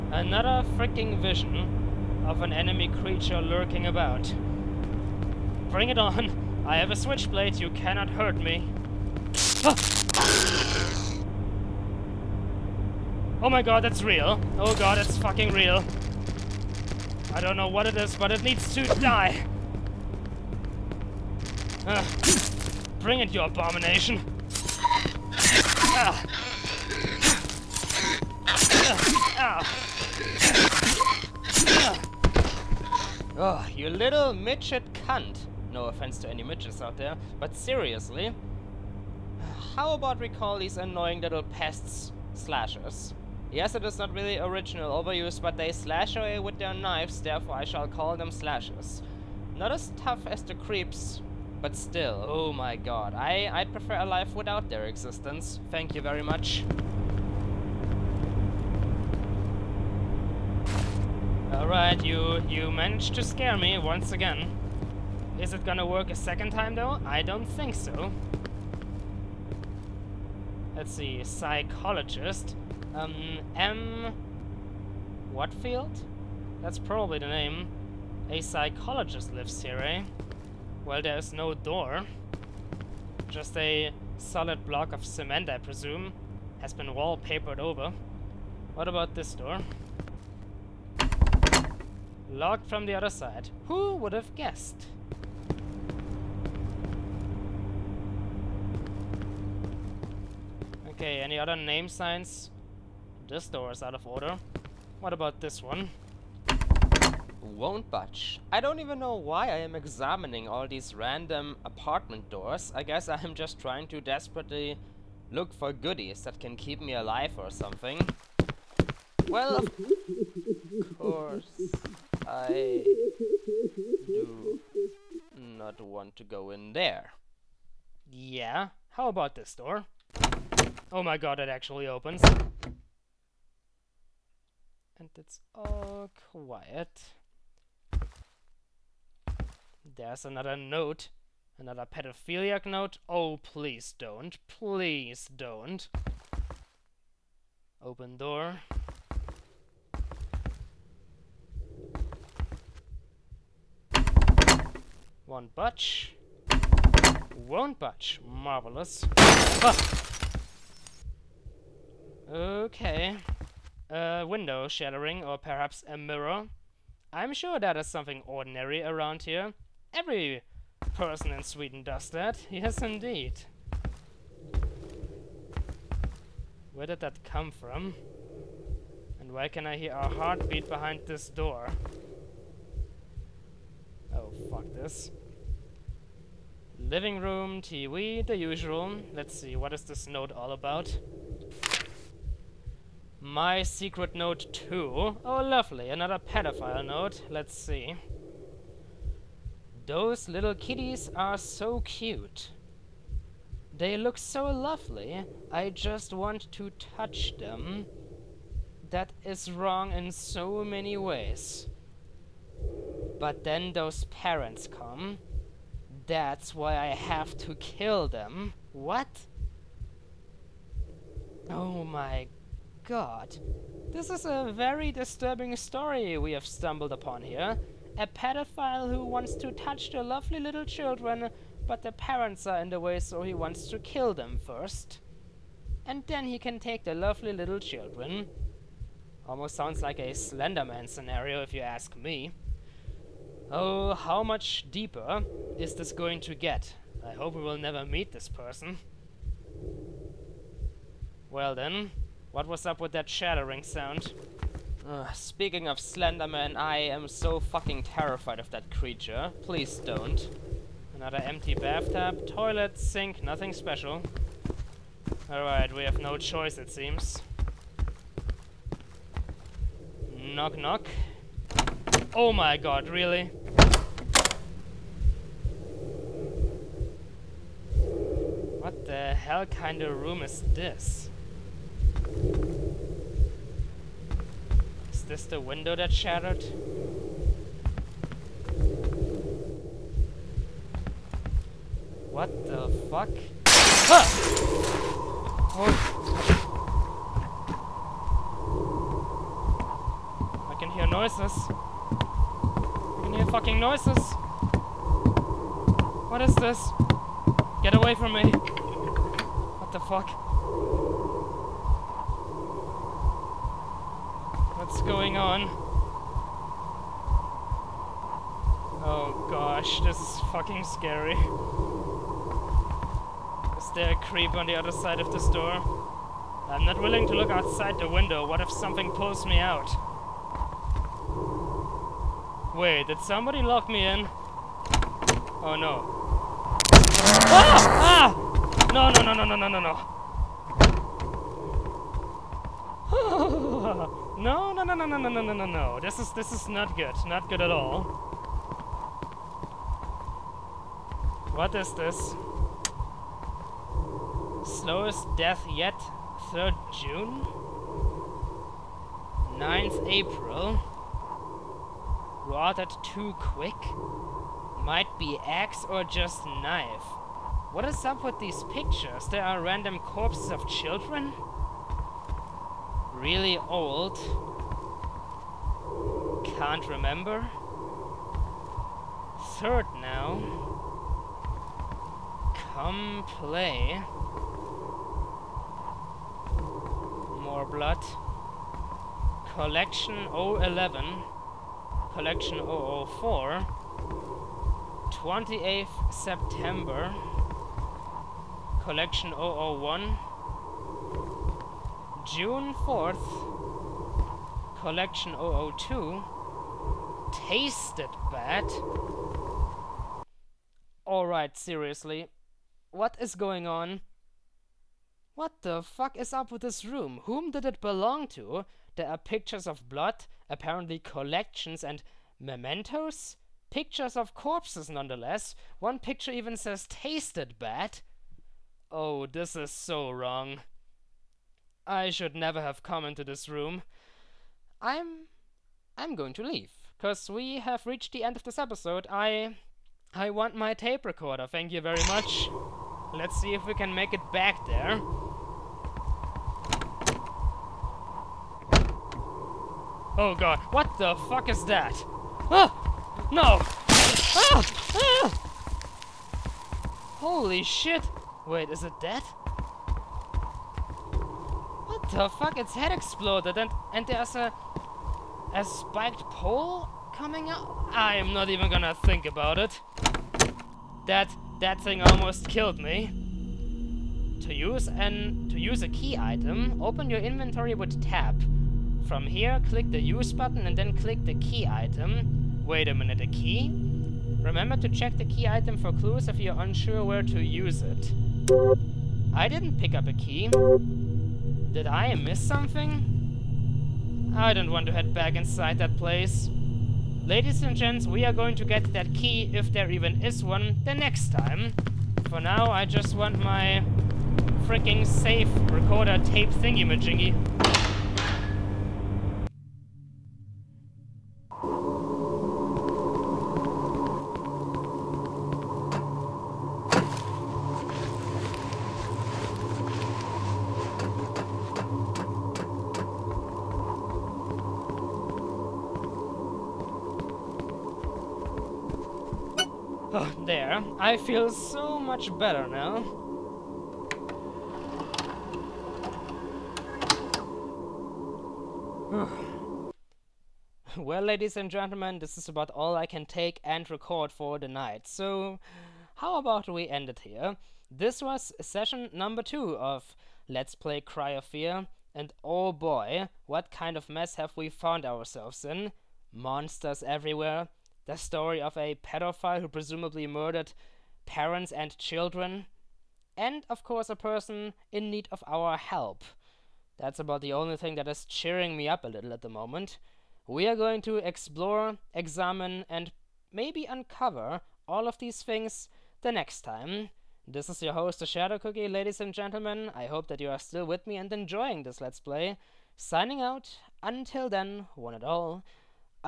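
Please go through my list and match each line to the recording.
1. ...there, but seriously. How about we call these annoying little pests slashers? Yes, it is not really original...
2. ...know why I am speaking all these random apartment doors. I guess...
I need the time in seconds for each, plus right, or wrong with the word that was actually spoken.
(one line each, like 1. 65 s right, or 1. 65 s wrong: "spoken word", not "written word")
1. 36 s right
2. 108 s wrong: "examining", not "speaking".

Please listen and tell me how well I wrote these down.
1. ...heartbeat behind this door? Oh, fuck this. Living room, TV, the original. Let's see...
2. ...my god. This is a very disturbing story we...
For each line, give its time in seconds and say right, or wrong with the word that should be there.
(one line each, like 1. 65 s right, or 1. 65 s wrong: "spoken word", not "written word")
1. 180 s wrong: "usual", not "original"
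2. 221 s right.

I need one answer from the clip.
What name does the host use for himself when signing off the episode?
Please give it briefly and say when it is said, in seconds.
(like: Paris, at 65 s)
The Shadow Cookie, at 577 s.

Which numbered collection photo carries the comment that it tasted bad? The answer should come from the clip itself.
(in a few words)
Collection 002.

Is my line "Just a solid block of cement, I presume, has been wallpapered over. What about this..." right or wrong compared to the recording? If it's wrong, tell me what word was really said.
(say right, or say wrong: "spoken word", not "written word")
right.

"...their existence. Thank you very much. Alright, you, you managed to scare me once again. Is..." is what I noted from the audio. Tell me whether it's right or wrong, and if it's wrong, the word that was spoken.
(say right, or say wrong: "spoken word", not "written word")
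right.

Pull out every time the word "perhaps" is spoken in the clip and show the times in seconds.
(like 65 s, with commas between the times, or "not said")
165 s.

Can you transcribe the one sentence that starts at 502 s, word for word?
For now, I just want my freaking safe recorder tape thingy-majingy.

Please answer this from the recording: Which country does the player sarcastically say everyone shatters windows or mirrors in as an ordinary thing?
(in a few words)
Sweden.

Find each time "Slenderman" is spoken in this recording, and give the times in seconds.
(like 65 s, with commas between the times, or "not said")
240 s, 255 s.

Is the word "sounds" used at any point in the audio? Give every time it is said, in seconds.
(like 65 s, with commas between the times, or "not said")
239 s, 253 s.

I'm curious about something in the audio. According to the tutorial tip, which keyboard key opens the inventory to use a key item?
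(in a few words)
Tab.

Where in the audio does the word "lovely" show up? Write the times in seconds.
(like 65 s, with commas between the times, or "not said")
195 s, 204 s, 230 s, 236 s.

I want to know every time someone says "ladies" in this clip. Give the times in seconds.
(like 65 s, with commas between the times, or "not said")
497 s, 541 s, 578 s.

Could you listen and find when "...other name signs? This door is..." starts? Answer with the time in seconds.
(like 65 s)
101 s.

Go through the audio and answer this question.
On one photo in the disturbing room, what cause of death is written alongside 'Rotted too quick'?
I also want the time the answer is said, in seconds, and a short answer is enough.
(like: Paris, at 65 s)
Axe or just knife, at 365 s.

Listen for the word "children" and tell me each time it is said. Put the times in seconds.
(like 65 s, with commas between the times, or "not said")
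230 s, 237 s, 370 s, 561 s.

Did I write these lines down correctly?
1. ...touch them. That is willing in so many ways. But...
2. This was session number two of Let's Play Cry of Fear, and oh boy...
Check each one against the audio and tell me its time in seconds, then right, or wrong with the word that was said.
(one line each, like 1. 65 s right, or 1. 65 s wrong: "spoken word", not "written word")
1. 206 s wrong: "wrong", not "willing"
2. 547 s right.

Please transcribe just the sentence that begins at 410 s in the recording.
Alright, seriously, what is going on?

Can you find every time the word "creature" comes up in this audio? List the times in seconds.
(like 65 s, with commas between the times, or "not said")
3 s, 258 s.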